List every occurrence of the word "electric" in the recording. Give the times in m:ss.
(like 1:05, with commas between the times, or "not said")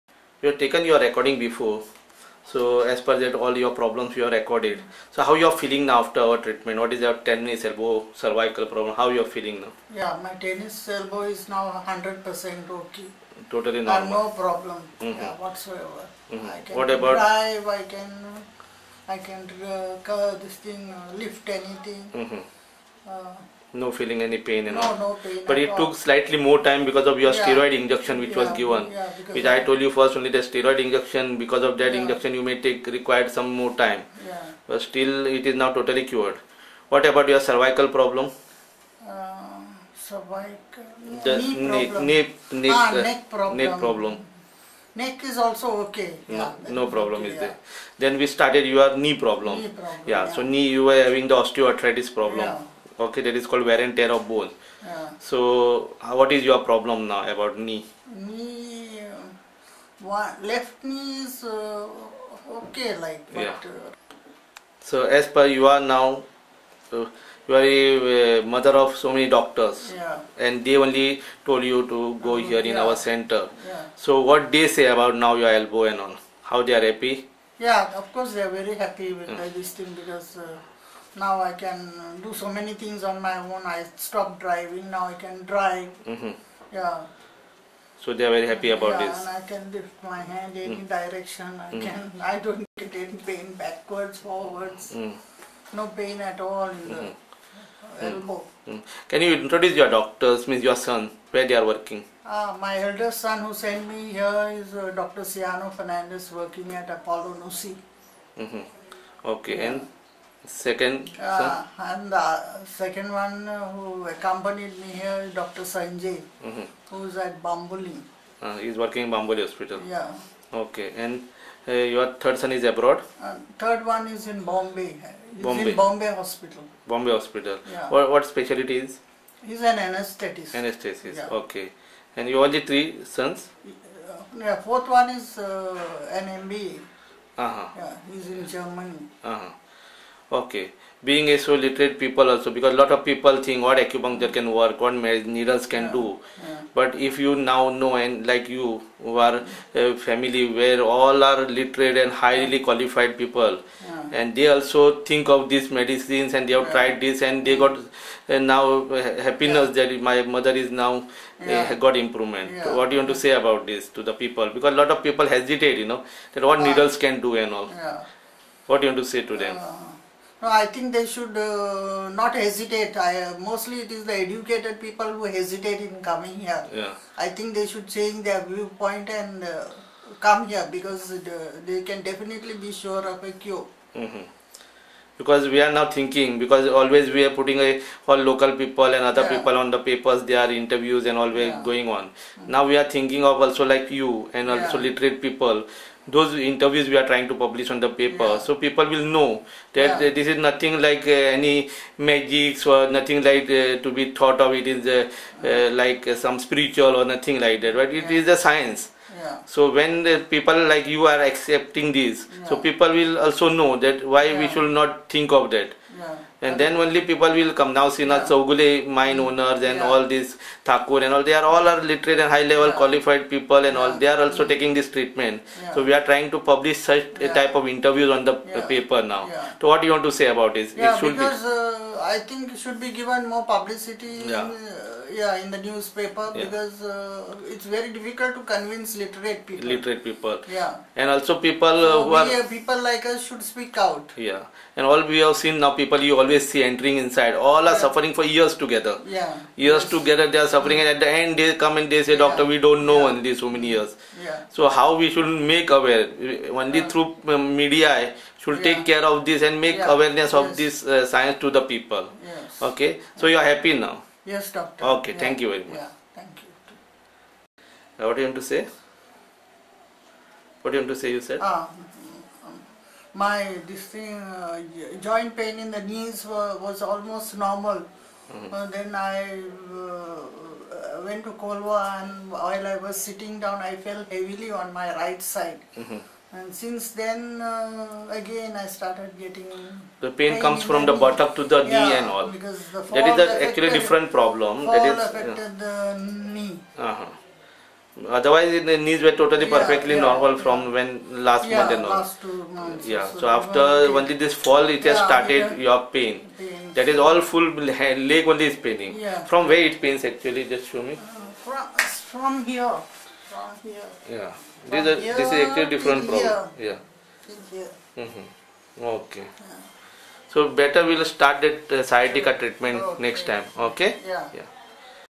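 not said.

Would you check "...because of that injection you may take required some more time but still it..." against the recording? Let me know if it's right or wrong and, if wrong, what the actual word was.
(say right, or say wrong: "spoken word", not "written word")
right.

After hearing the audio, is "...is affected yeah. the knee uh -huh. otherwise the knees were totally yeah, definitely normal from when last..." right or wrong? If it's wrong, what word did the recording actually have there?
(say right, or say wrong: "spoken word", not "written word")
wrong: "perfectly", not "definitely".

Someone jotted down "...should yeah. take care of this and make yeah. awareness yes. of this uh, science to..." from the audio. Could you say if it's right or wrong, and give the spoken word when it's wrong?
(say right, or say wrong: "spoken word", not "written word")
right.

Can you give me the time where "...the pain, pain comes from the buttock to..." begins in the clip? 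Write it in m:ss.
4:49.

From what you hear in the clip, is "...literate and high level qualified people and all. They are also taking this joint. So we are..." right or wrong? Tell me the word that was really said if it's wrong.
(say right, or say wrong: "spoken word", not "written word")
wrong: "treatment", not "joint".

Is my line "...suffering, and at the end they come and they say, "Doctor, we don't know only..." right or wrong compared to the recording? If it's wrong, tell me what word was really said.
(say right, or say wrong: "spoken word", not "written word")
right.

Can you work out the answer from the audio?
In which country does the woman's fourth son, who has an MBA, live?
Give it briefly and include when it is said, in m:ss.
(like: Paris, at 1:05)
Germany, at 2:18.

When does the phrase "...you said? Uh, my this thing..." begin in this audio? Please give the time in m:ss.
4:31.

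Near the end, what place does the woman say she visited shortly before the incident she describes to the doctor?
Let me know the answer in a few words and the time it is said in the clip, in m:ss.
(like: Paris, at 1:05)
Colva, at 4:41.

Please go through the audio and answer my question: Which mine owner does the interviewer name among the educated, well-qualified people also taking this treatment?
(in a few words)
Sina Chaugule.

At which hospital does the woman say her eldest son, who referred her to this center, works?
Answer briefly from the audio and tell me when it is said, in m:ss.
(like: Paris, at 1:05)
Apollo Nusi, at 1:46.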